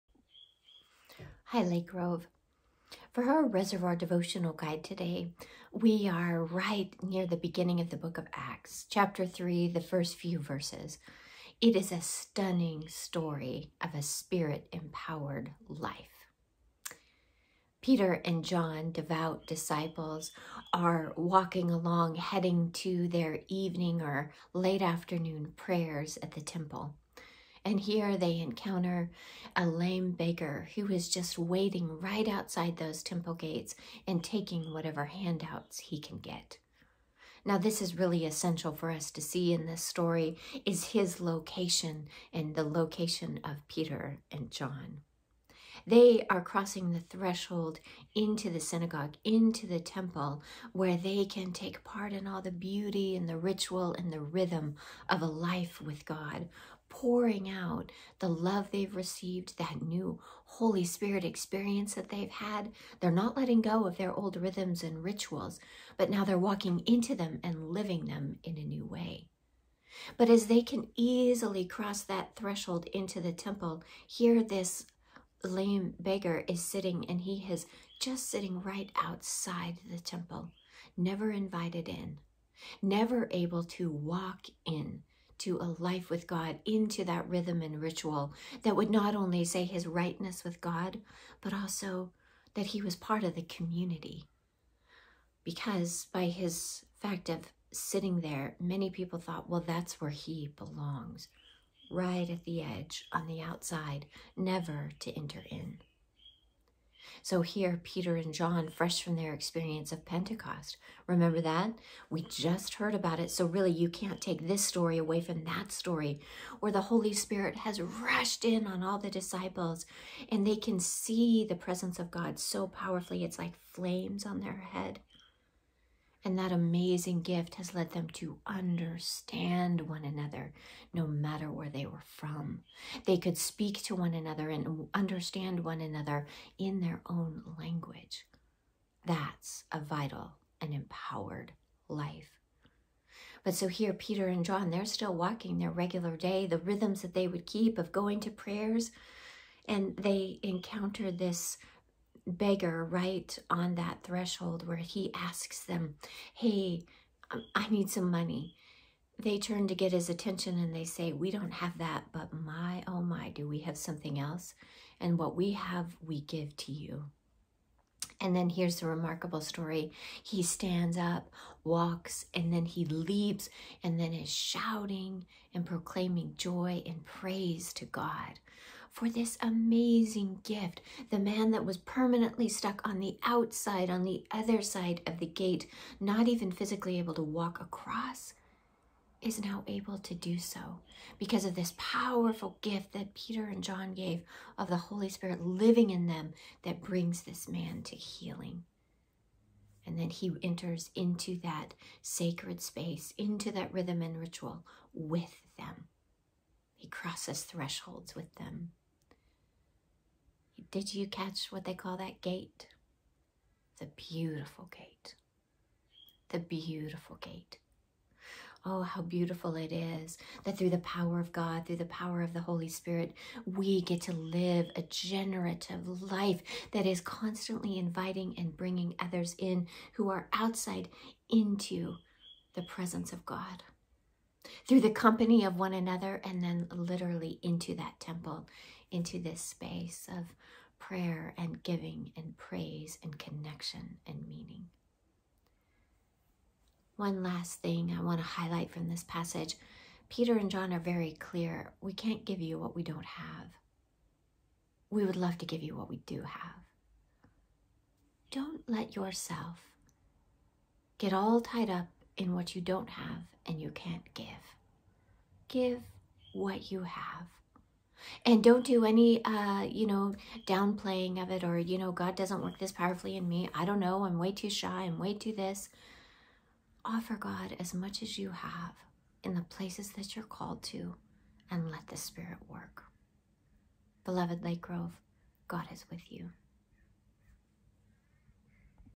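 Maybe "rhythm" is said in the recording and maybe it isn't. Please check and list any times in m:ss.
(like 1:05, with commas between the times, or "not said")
0:54, 1:04, 1:27, 2:26, 3:23.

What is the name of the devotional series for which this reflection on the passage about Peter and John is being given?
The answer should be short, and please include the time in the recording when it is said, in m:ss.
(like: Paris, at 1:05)
Reservoir Devotional Guide, at 0:03.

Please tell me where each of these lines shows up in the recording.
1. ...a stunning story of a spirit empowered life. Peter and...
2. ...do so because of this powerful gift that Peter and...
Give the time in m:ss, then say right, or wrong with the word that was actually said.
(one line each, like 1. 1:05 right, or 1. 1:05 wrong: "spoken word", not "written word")
1. 0:11 right
2. 3:10 right.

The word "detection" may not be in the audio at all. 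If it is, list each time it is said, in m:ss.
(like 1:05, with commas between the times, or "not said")
not said.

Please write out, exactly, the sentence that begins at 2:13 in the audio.
They could speak to one another and understand one another in their own language.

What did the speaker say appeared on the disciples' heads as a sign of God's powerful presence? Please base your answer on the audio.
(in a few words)
Flames.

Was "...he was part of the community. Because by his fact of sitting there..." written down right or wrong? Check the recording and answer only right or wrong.
right.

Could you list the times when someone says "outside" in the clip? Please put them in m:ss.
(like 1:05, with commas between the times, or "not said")
0:32, 1:19, 1:43, 3:03, 3:50.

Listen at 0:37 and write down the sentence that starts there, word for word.
Now, this is really essential for us to see in this story is his location and the location of Peter and John.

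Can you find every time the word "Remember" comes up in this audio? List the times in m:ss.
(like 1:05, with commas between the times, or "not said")
1:51.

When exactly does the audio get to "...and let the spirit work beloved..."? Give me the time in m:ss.
4:41.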